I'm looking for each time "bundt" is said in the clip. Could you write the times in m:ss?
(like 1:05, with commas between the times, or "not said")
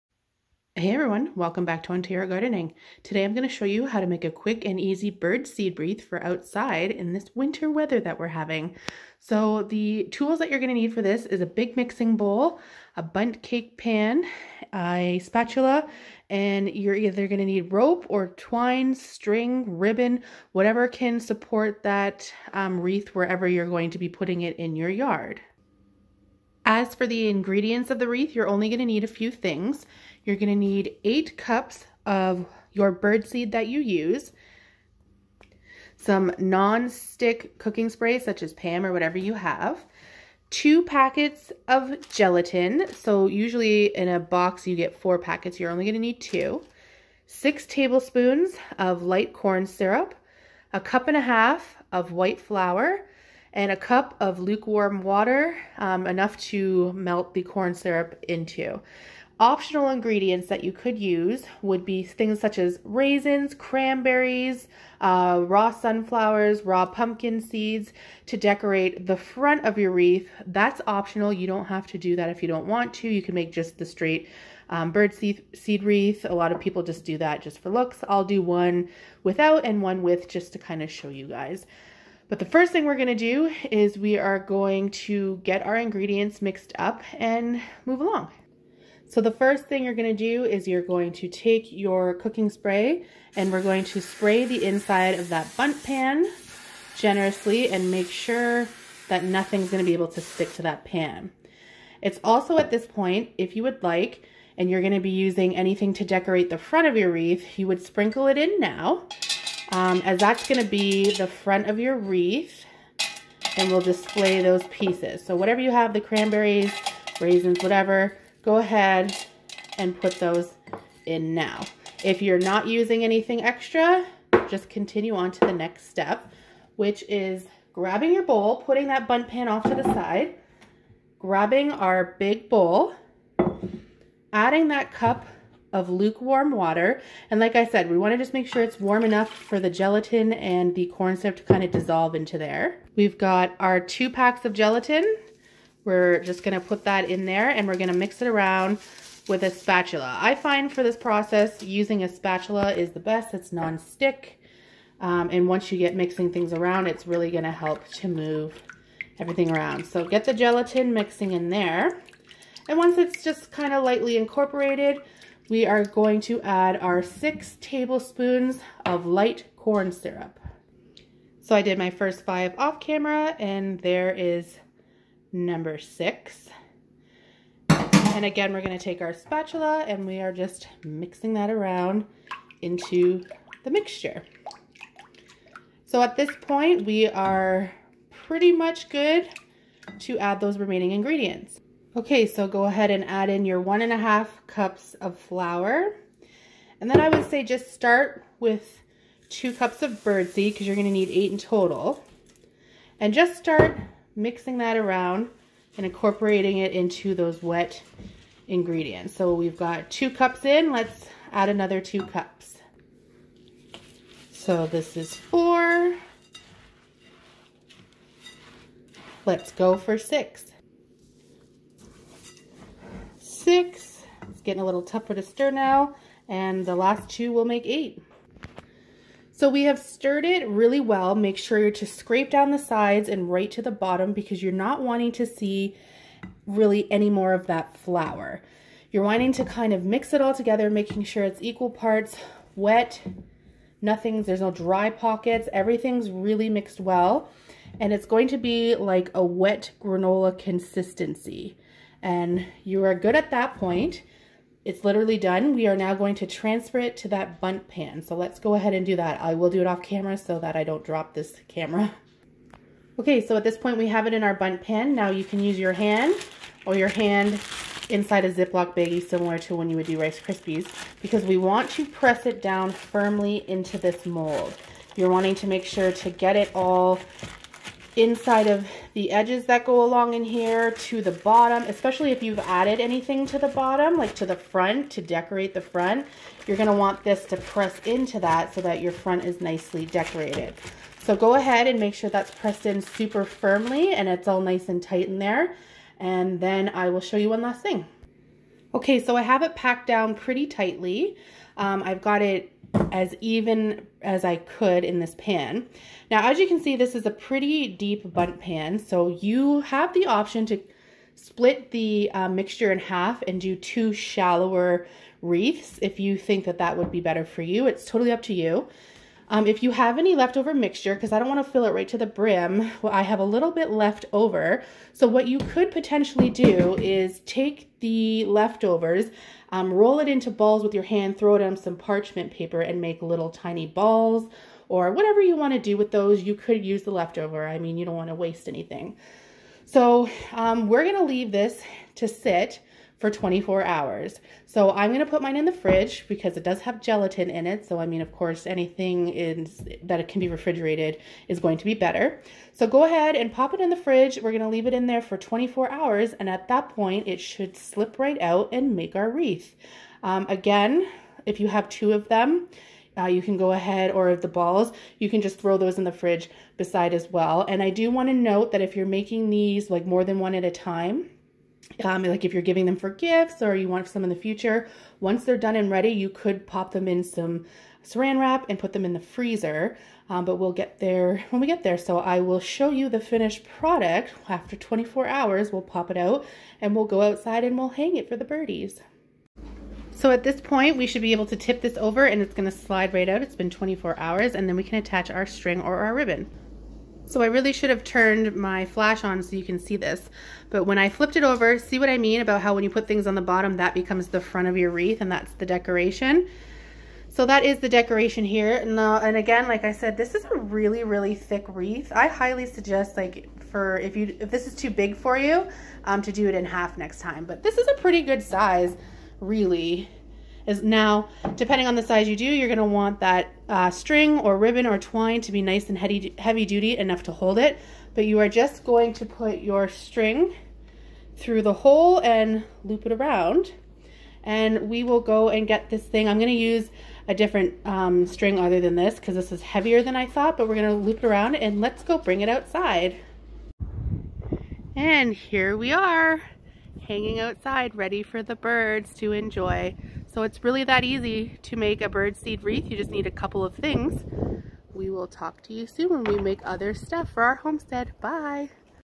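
0:13, 1:35, 4:17, 4:24, 5:08.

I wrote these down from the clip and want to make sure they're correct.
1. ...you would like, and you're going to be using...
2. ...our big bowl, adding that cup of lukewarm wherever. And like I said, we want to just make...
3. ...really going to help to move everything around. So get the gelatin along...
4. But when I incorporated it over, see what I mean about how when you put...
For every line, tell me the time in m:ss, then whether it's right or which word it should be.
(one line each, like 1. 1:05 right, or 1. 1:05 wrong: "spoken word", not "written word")
1. 1:43 right
2. 2:11 wrong: "water", not "wherever"
3. 2:37 wrong: "mixing", not "along"
4. 6:40 wrong: "flipped", not "incorporated".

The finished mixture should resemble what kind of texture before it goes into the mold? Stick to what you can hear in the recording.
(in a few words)
Wet granola.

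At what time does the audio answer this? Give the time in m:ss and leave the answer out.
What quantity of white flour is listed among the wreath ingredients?
0:50.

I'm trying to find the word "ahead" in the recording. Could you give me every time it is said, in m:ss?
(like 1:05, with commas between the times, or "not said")
1:58, 3:12, 4:18, 4:51, 5:52, 6:03.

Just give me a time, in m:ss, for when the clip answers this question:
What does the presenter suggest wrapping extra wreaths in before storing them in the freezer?
6:17.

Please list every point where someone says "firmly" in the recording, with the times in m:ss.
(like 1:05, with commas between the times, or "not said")
4:32, 4:53.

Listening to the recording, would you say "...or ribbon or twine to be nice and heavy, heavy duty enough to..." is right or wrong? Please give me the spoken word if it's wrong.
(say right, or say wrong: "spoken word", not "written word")
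right.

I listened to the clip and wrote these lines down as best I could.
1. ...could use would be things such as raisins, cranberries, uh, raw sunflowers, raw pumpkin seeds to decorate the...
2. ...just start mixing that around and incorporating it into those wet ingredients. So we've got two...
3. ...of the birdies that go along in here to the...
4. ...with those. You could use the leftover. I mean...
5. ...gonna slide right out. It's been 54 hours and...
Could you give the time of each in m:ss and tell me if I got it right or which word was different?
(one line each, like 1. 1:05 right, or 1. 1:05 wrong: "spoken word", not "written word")
1. 1:00 right
2. 3:23 right
3. 4:38 wrong: "edges", not "birdies"
4. 5:35 right
5. 6:32 wrong: "24", not "54".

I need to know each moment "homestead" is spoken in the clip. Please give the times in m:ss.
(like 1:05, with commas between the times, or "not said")
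7:37.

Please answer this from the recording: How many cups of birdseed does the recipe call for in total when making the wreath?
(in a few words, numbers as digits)
8.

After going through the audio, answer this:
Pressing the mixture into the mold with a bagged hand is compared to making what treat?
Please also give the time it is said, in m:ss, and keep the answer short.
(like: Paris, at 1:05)
Rice Krispies, at 4:29.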